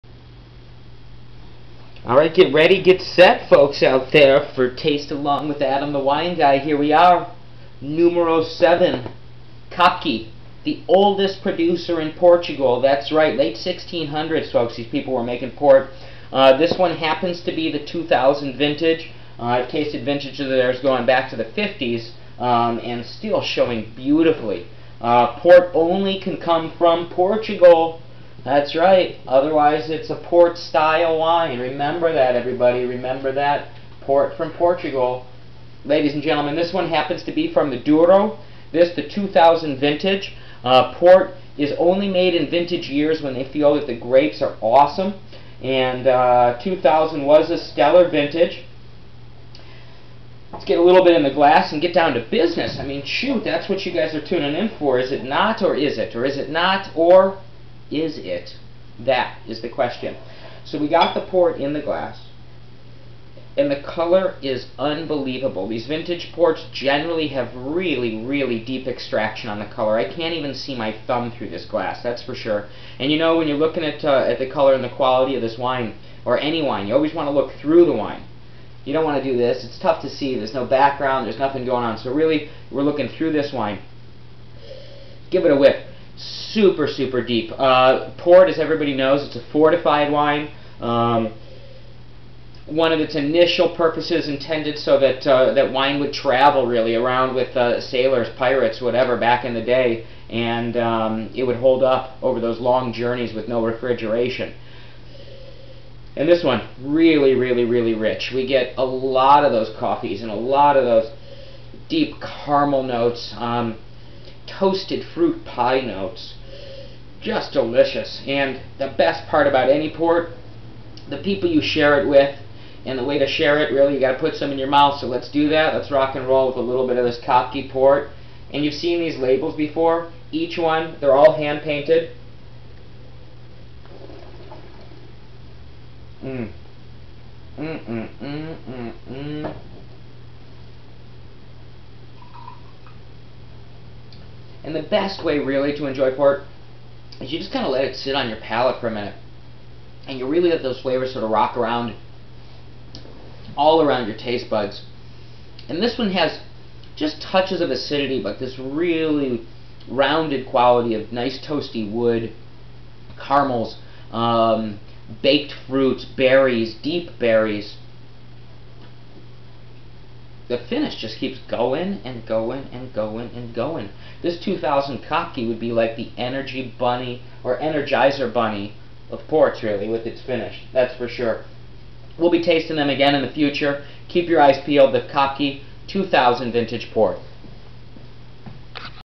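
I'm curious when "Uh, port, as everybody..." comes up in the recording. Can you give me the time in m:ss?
1:27.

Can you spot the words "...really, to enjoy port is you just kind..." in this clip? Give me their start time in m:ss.
2:25.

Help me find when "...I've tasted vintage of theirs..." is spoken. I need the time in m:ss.
0:19.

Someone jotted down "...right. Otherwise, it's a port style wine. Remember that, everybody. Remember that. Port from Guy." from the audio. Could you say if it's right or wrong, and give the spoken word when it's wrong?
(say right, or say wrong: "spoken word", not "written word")
wrong: "Portugal", not "Guy".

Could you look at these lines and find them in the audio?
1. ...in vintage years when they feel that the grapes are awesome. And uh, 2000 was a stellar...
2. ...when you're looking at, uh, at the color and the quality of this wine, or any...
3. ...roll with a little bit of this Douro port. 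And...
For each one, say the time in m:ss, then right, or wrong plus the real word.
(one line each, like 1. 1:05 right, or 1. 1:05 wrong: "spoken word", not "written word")
1. 0:42 right
2. 1:13 right
3. 2:06 wrong: "Kopke", not "Douro".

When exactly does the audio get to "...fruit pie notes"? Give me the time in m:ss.
1:55.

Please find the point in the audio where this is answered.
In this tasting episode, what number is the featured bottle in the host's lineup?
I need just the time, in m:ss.
0:07.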